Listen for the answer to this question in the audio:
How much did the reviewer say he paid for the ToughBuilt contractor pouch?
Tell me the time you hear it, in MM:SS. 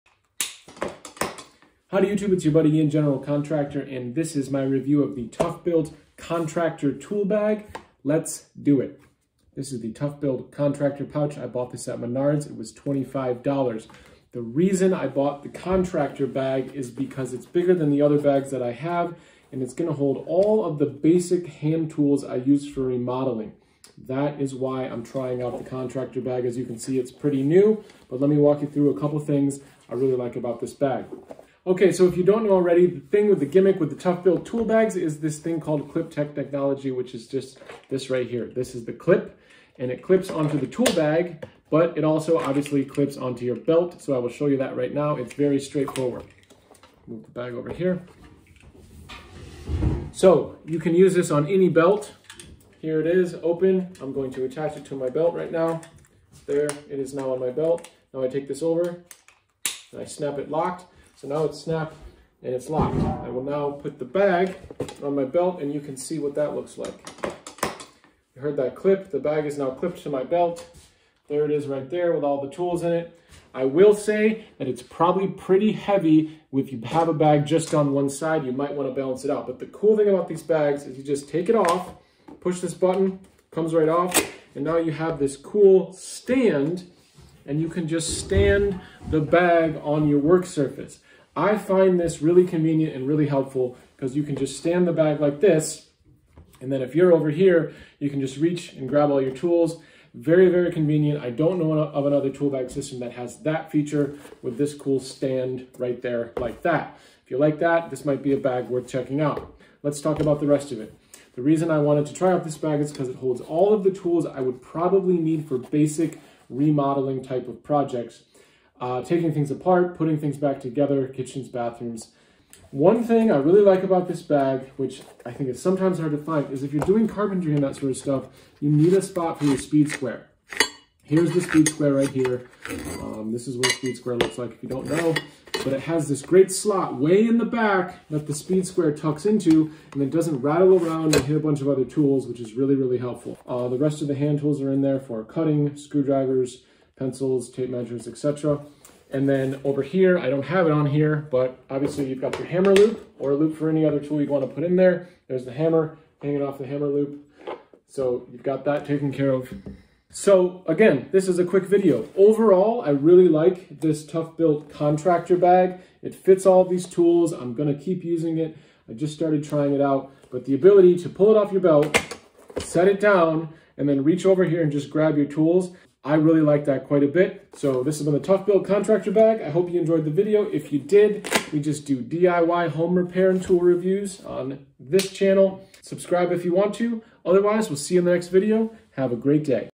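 00:12.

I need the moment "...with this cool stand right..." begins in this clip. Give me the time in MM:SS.
01:44.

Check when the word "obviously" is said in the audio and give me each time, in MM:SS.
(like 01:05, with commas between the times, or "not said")
00:42, 02:31.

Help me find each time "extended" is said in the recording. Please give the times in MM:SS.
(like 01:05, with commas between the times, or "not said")
not said.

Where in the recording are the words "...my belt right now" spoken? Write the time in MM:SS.
00:54.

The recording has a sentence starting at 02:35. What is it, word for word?
There's the hammer hanging off the hammer loop.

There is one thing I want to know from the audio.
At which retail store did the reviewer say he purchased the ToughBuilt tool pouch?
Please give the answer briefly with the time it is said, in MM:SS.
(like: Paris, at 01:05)
Menards, at 00:11.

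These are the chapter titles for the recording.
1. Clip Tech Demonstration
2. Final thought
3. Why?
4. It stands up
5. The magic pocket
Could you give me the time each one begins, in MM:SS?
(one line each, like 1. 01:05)
1. 00:31
2. 02:42
3. 00:16
4. 01:24
5. 02:02.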